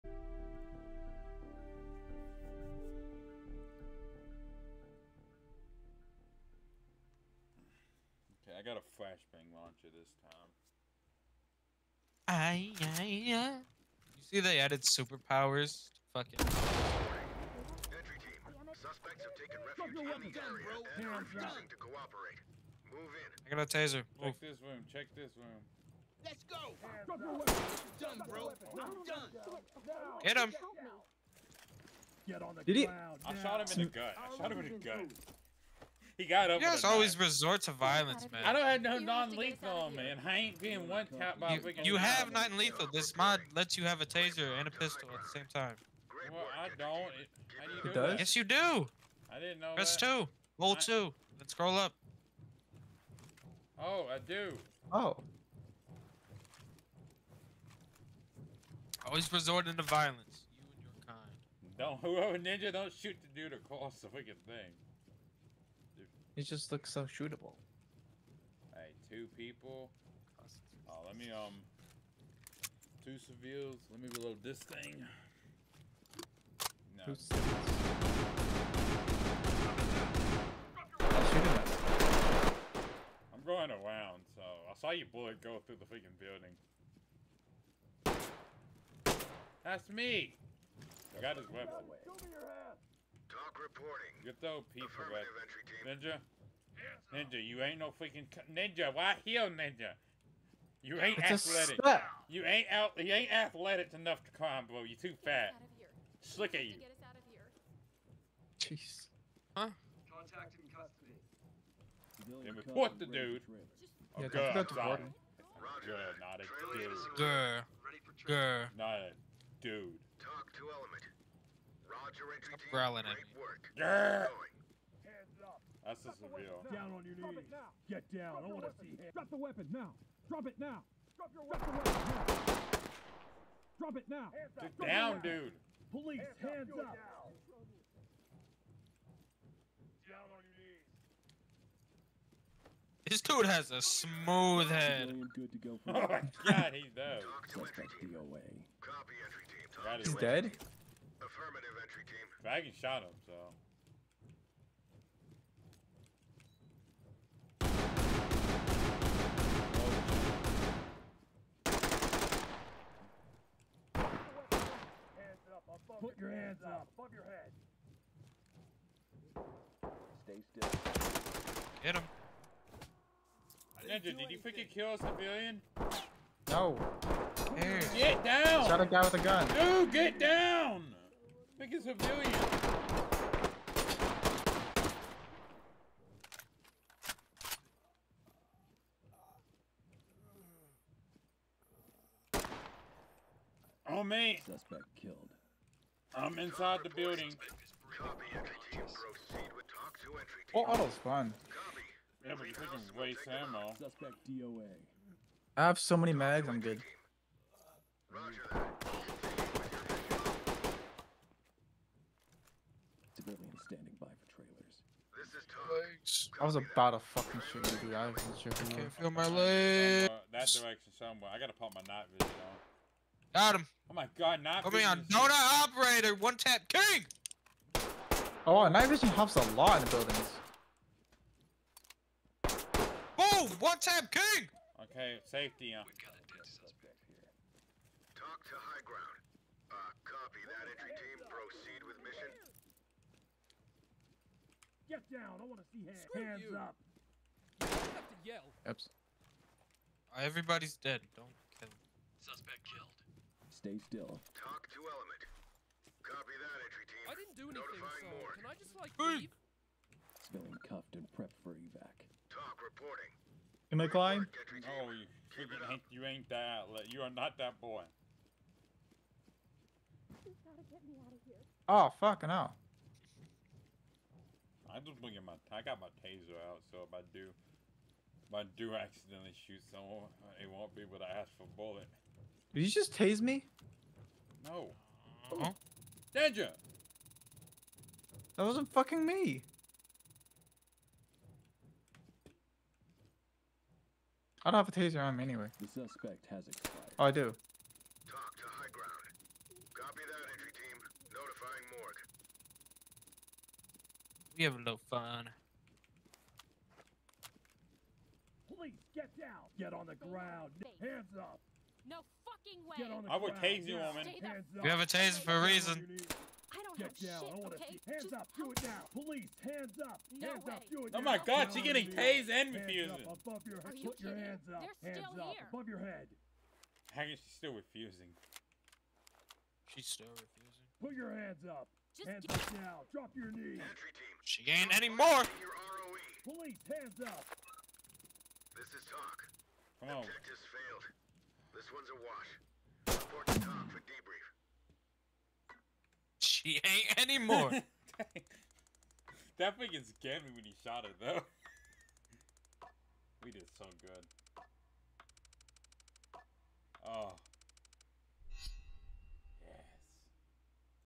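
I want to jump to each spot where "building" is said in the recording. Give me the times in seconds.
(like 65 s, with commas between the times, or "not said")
86 s, 196 s, 229 s.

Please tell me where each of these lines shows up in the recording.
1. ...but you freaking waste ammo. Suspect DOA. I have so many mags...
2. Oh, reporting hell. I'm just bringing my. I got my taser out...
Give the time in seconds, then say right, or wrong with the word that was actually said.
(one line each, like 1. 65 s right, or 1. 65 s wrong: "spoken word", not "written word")
1. 202 s right
2. 271 s wrong: "fucking", not "reporting".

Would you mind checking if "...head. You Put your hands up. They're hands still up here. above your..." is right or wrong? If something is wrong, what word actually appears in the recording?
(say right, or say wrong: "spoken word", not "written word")
right.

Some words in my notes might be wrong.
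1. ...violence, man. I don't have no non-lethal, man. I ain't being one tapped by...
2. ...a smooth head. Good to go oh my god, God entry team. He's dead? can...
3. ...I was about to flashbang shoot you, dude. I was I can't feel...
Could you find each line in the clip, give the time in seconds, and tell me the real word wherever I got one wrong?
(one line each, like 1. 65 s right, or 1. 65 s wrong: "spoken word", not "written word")
1. 37 s right
2. 143 s wrong: "Copy", not "God"
3. 216 s wrong: "fucking", not "flashbang".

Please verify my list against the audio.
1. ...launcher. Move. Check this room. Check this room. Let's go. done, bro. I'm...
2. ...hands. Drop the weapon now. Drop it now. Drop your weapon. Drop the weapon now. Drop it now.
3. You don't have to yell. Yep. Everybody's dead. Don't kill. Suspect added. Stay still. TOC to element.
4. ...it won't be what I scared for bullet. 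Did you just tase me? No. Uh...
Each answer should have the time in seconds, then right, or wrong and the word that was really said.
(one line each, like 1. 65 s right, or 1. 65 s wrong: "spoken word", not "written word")
1. 23 s wrong: "taser", not "launcher"
2. 128 s right
3. 246 s wrong: "killed", not "added"
4. 280 s wrong: "asked", not "scared".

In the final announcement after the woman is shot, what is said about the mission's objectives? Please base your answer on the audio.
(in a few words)
Objectives failed.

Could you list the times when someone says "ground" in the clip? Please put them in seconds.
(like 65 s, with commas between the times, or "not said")
238 s, 309 s.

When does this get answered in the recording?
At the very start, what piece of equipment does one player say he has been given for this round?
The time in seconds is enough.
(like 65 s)
9 s.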